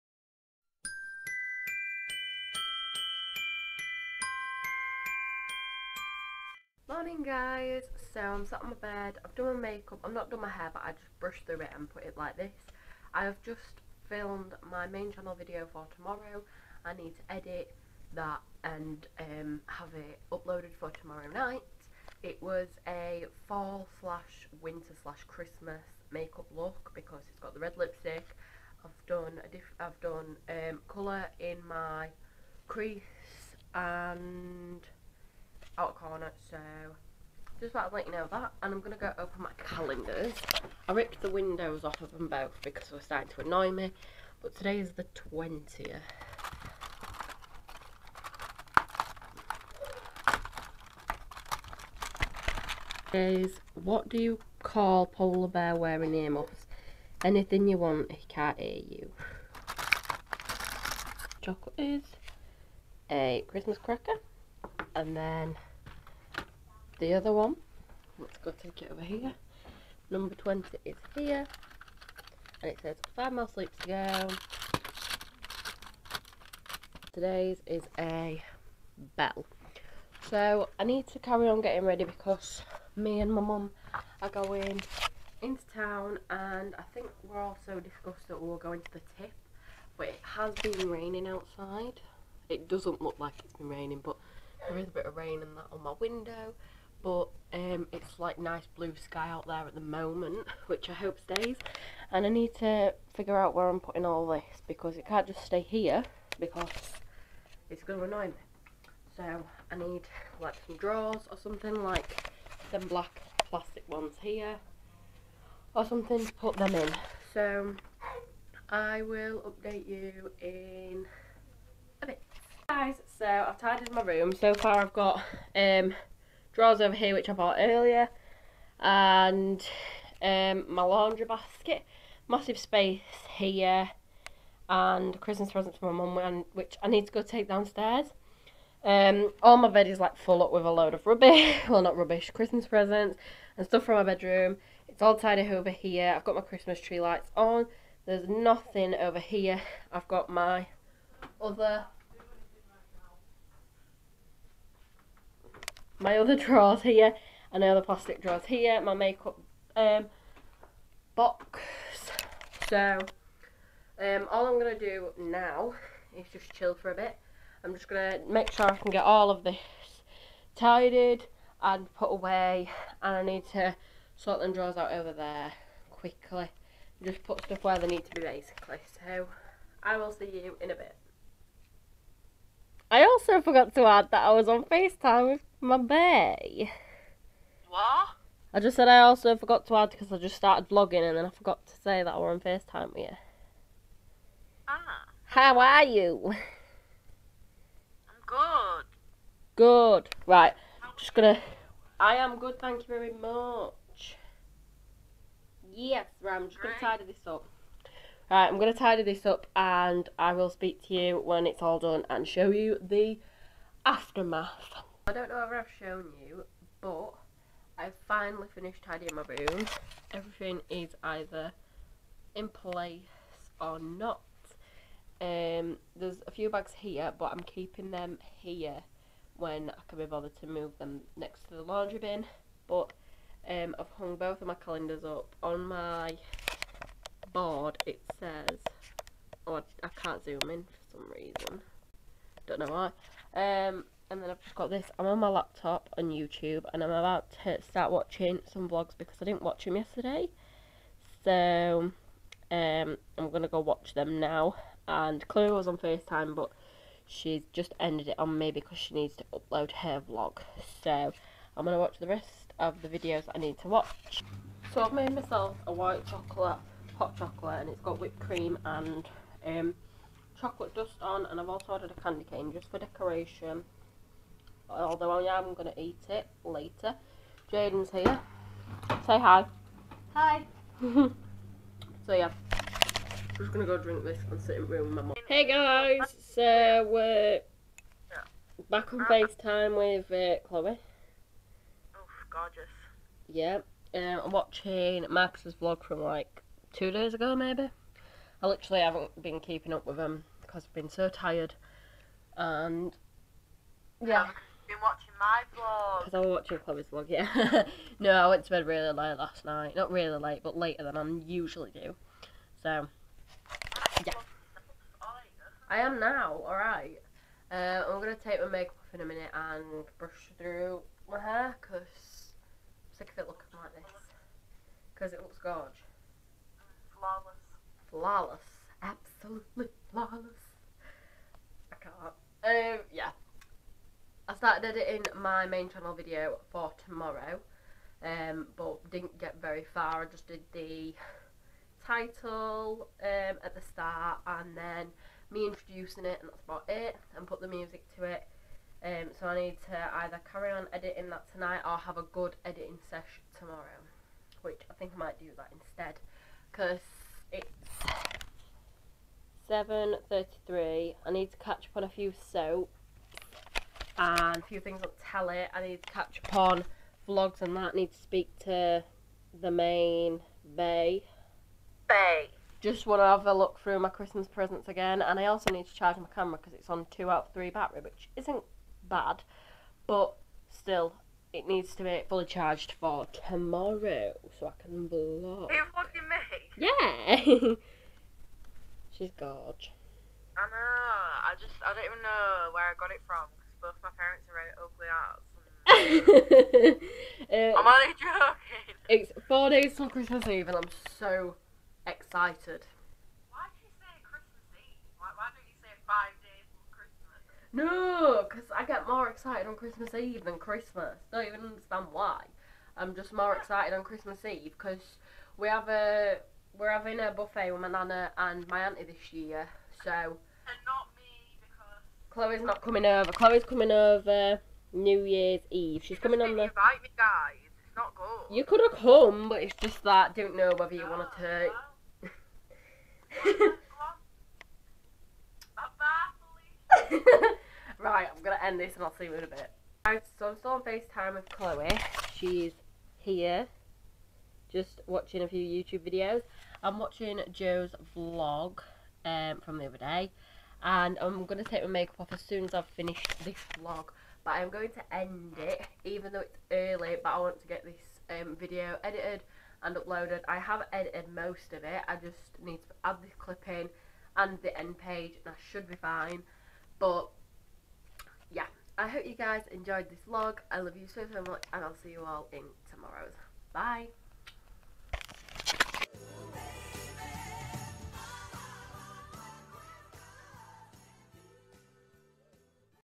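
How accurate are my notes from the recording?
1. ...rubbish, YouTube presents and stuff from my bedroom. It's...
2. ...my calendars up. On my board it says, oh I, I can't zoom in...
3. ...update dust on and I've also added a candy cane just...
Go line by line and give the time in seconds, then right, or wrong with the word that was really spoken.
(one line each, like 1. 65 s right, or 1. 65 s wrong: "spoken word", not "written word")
1. 141 s wrong: "Christmas", not "YouTube"
2. 234 s right
3. 270 s wrong: "chocolate", not "update".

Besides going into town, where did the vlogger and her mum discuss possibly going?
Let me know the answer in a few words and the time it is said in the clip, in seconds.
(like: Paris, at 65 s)
The tip, at 88 s.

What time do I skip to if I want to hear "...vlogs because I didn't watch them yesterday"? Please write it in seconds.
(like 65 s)
248 s.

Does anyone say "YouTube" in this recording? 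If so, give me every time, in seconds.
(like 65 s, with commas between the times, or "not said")
246 s, 445 s.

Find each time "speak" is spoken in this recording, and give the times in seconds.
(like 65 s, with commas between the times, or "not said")
210 s, 367 s.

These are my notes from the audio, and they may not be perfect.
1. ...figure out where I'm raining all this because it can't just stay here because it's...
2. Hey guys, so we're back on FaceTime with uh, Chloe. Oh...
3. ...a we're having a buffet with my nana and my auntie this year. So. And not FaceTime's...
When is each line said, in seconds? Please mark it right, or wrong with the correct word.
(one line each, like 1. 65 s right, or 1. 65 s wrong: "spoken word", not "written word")
1. 103 s wrong: "putting", not "raining"
2. 285 s right
3. 415 s wrong: "Chloe", not "FaceTime".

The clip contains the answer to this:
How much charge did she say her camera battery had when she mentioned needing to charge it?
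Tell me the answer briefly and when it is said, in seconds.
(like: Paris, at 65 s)
2 out of 3, at 376 s.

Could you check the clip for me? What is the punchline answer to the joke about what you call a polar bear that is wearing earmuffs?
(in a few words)
Anything you want.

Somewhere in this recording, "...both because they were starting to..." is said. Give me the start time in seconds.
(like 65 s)
42 s.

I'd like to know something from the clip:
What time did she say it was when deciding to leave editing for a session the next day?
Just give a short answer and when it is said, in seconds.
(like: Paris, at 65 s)
7:33, at 359 s.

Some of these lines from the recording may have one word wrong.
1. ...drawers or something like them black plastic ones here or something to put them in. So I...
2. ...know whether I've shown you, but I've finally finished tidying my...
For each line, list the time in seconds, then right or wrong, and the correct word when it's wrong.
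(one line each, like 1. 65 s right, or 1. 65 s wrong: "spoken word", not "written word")
1. 110 s right
2. 215 s right.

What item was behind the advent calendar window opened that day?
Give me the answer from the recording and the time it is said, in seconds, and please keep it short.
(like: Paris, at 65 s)
A bell, at 77 s.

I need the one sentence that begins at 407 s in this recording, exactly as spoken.
No, because I get more excited on Christmas Eve than Christmas.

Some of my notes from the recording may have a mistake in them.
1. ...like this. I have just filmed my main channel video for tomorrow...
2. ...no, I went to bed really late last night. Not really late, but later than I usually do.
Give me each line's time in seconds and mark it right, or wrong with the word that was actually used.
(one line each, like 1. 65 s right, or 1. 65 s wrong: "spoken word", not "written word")
1. 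12 s right
2. 307 s right.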